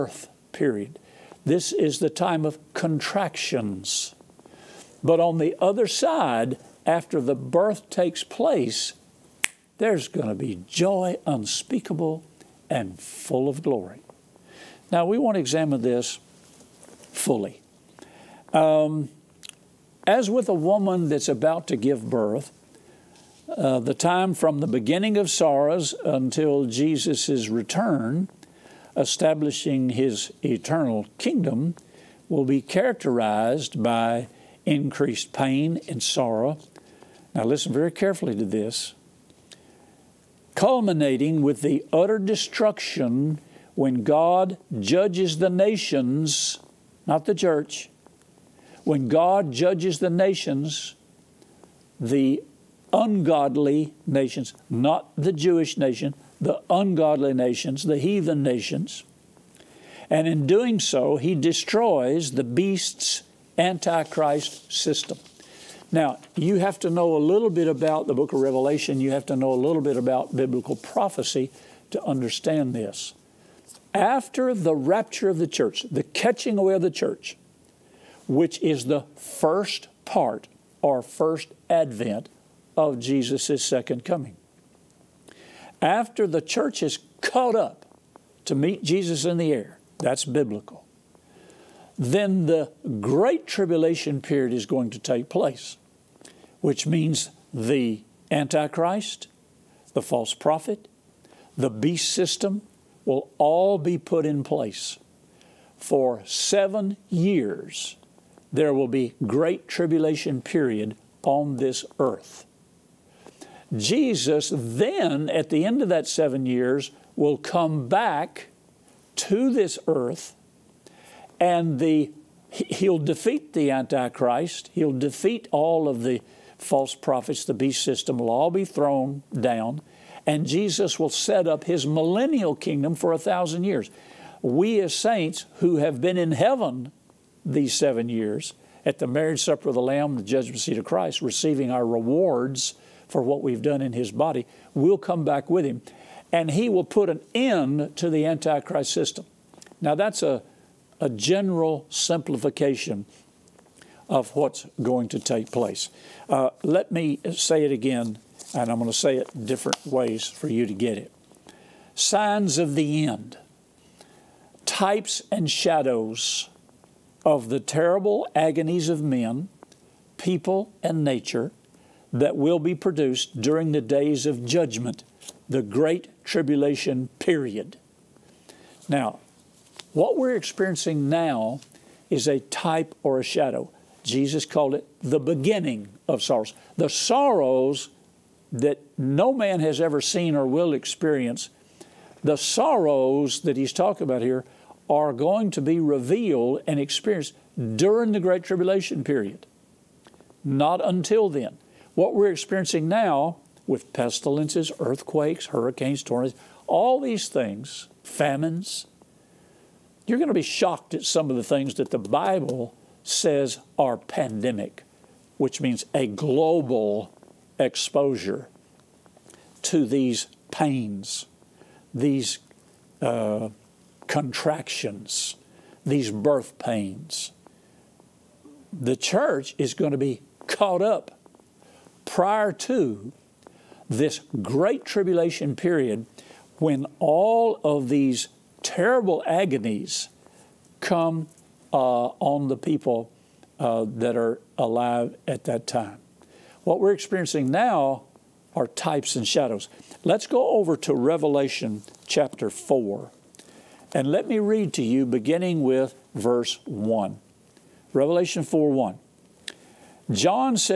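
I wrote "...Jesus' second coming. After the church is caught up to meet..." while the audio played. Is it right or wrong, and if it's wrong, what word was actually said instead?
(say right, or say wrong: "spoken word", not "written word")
right.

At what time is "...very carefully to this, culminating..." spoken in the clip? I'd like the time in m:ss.
0:37.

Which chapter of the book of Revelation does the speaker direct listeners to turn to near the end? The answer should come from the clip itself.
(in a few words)
Chapter 4.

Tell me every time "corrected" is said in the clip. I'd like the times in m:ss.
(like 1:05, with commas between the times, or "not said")
not said.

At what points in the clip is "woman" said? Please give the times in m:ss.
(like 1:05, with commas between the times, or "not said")
0:20.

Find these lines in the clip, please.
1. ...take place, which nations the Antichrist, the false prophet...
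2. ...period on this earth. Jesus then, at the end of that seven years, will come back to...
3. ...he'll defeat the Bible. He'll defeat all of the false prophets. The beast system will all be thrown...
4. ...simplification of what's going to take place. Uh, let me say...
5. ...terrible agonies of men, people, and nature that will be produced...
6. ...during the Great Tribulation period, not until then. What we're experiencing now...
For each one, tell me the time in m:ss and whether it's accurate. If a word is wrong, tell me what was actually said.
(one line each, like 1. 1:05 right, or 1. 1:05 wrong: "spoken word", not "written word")
1. 1:34 wrong: "means", not "nations"
2. 1:50 right
3. 2:02 wrong: "Antichrist", not "Bible"
4. 2:31 right
5. 2:47 right
6. 3:17 right.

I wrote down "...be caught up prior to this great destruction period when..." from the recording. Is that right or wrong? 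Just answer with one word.
wrong.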